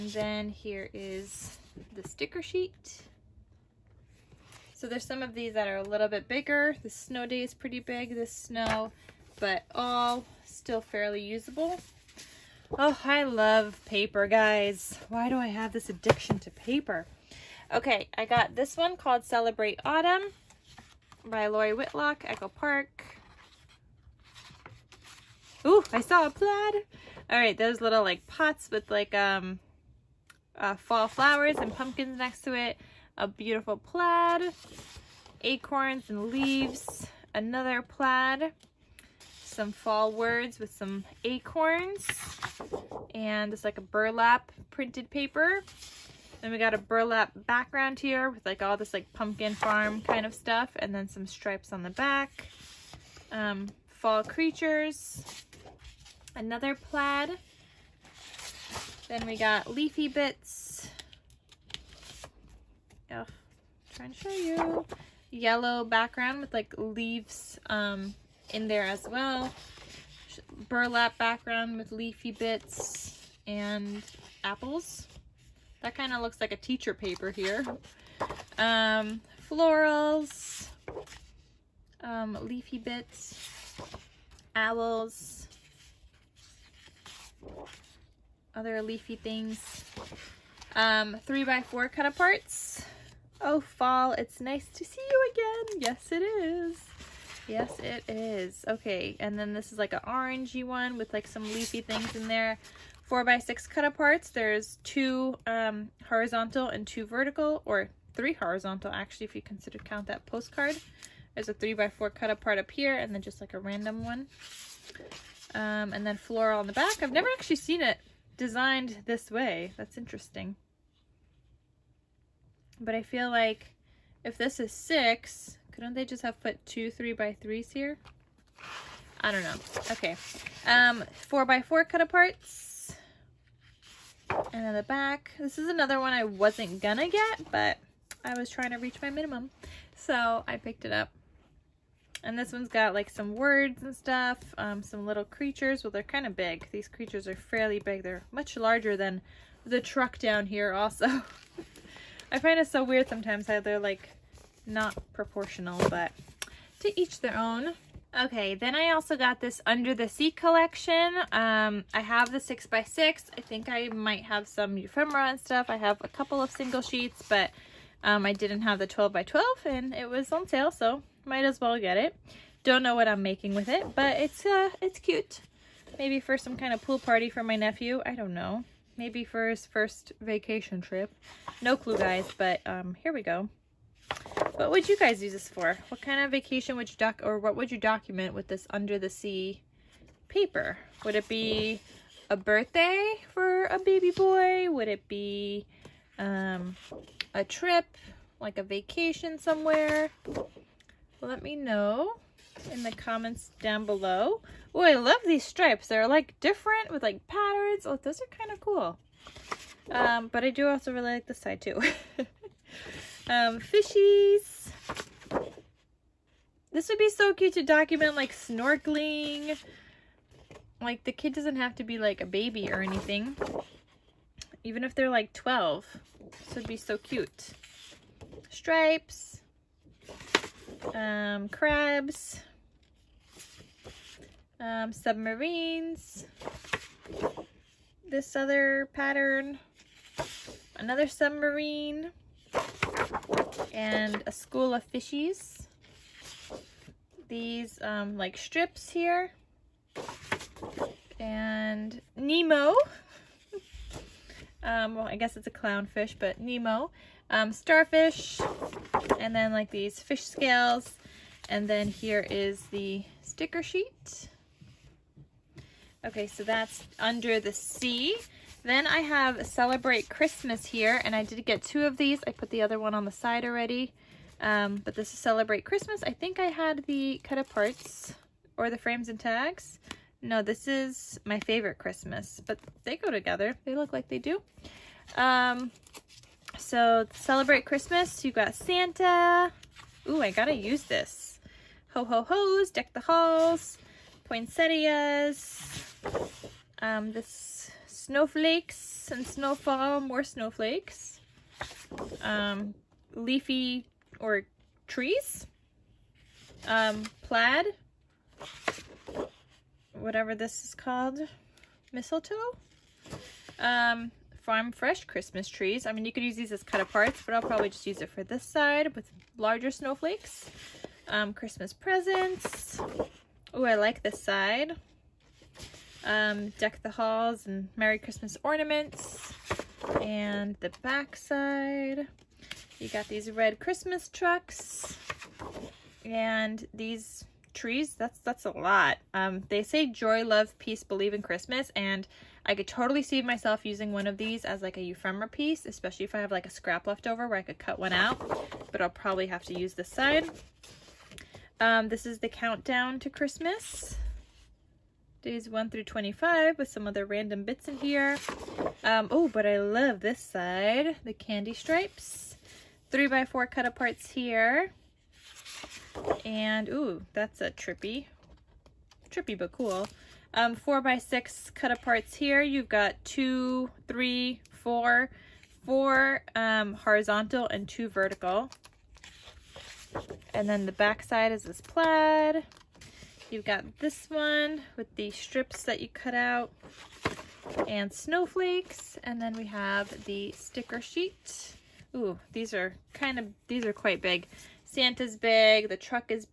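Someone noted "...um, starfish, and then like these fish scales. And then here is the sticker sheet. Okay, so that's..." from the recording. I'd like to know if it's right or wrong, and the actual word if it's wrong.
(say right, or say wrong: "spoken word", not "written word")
right.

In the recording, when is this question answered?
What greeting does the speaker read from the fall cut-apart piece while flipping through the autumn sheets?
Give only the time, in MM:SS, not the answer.
01:33.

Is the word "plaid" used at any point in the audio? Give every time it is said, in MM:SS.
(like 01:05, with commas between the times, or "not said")
00:26, 00:33, 00:37, 00:56, 05:07, 06:21.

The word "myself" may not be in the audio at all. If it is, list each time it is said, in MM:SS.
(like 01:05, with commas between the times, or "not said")
05:43.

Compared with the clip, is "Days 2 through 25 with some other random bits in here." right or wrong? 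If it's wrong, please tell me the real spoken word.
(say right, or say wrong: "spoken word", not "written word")
wrong: "1", not "2".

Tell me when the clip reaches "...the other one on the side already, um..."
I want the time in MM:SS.
04:32.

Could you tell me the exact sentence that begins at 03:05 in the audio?
What kind of vacation would you doc or what would you document with this under the sea paper?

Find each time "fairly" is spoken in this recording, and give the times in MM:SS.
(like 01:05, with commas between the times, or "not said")
00:10, 02:27.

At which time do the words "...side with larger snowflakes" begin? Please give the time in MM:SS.
05:18.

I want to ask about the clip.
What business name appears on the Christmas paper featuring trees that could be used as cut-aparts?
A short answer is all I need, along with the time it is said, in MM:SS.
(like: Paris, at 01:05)
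Farm Fresh Christmas Trees, at 05:14.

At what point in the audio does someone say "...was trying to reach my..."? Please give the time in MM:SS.
02:18.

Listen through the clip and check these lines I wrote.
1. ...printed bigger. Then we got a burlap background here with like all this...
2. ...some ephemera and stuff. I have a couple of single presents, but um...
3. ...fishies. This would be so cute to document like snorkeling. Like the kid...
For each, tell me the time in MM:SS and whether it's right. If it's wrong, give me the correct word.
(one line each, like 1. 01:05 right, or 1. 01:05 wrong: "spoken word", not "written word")
1. 00:44 wrong: "paper", not "bigger"
2. 02:44 wrong: "sheets", not "presents"
3. 03:33 right.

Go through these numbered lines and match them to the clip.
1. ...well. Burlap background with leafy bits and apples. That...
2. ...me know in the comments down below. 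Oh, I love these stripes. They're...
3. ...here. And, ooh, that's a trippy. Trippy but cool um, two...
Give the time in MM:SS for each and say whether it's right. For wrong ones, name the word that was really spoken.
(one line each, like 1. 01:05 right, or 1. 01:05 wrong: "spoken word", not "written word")
1. 01:09 right
2. 03:21 right
3. 06:04 wrong: "four", not "two".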